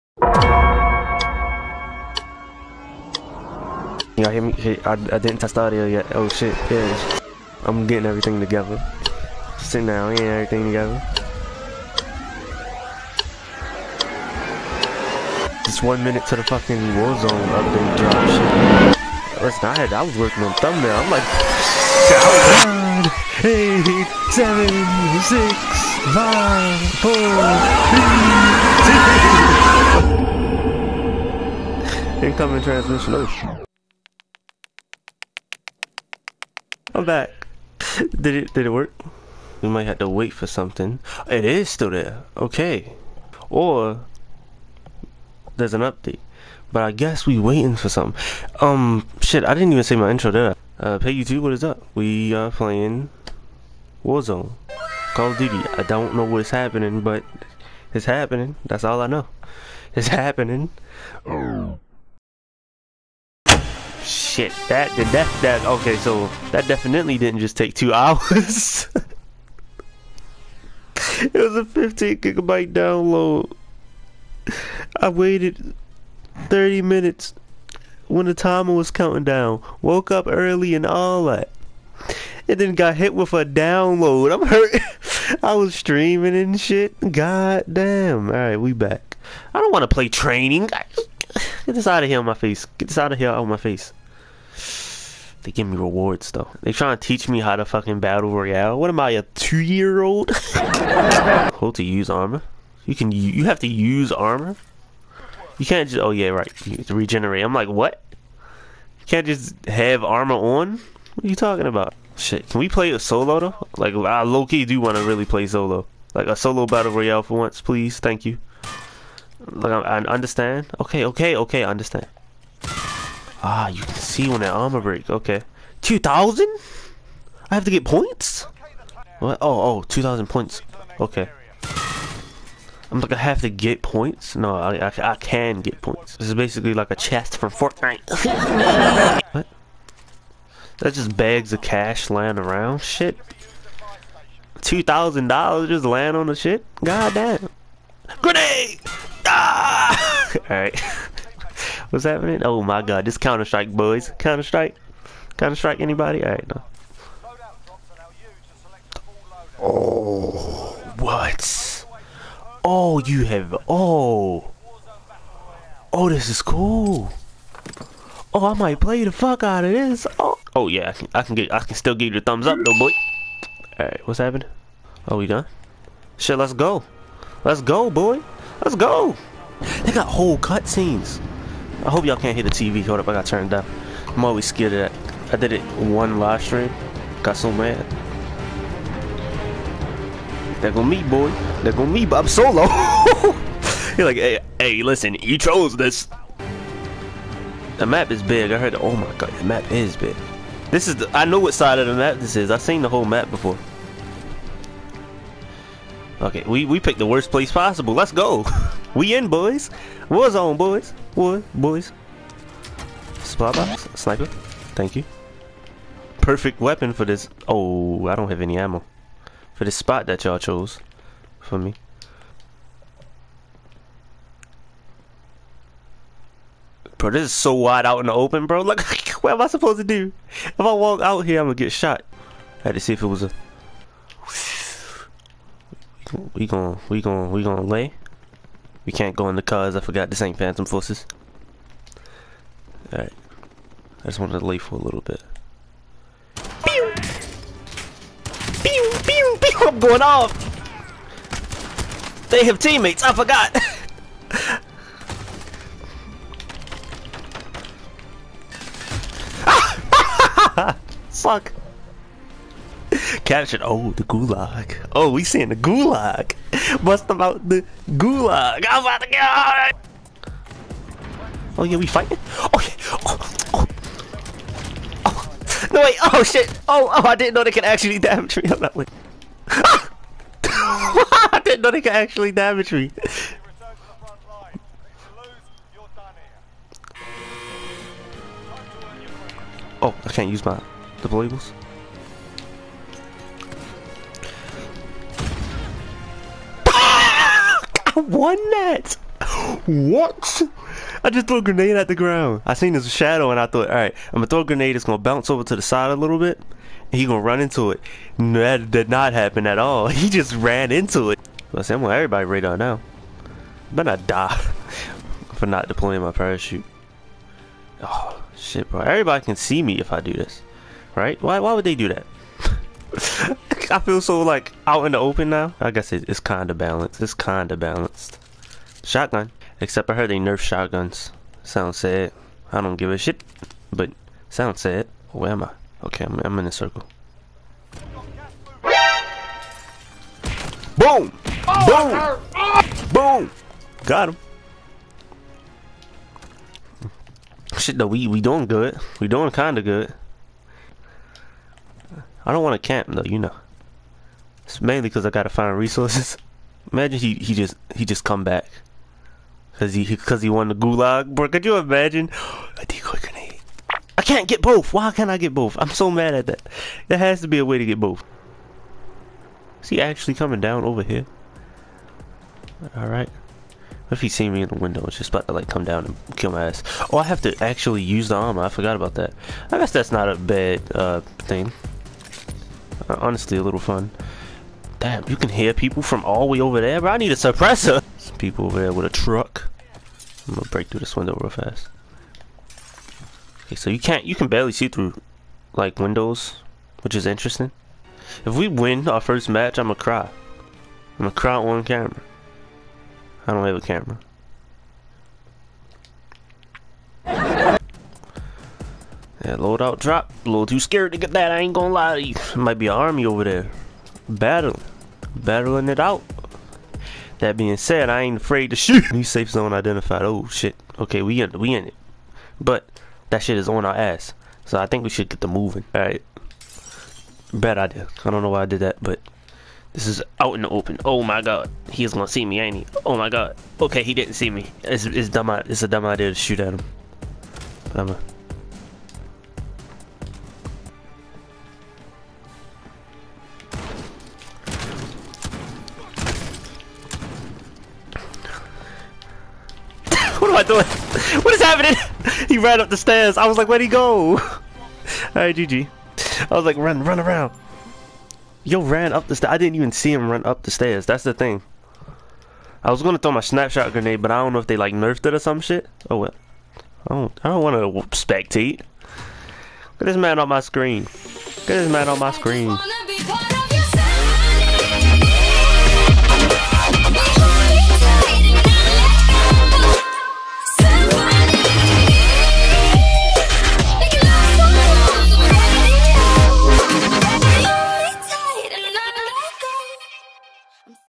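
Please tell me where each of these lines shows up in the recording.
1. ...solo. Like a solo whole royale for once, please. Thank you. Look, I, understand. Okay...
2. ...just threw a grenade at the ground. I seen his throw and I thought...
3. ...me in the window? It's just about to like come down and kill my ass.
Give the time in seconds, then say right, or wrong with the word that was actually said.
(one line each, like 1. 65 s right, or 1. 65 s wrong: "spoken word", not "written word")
1. 115 s wrong: "battle", not "whole"
2. 301 s wrong: "shadow", not "throw"
3. 374 s right.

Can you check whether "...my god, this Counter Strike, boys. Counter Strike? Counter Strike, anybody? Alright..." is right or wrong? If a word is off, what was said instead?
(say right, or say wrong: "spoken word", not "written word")
right.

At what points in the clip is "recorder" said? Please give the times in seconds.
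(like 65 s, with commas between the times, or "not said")
not said.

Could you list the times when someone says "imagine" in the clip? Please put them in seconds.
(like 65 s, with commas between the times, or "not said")
356 s, 361 s.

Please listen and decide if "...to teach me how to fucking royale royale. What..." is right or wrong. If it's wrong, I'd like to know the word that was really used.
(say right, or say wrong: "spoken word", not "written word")
wrong: "battle", not "royale".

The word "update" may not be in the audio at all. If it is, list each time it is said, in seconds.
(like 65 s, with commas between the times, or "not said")
17 s, 45 s.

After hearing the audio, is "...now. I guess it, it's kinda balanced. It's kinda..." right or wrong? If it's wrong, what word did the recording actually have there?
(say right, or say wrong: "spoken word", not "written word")
right.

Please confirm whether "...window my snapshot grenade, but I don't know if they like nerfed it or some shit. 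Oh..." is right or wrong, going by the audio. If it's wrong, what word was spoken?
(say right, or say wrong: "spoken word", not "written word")
wrong: "throw", not "window".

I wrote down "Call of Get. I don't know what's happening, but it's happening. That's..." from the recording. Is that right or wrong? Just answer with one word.
wrong.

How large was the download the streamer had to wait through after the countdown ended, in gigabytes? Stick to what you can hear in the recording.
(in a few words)
15.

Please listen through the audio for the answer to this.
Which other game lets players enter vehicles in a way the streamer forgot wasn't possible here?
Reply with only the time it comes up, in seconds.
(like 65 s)
240 s.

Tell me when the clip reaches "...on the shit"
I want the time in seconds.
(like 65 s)
146 s.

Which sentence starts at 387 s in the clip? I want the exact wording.
Some people over there with a truck.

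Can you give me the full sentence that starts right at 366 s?
There has to be a way to get both.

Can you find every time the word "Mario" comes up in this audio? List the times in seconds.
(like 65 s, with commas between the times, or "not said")
not said.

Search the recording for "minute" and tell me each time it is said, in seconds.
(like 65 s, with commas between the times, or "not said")
16 s, 76 s.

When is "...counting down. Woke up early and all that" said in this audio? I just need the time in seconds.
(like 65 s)
78 s.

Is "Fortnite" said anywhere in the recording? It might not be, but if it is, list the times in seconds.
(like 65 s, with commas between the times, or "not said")
137 s.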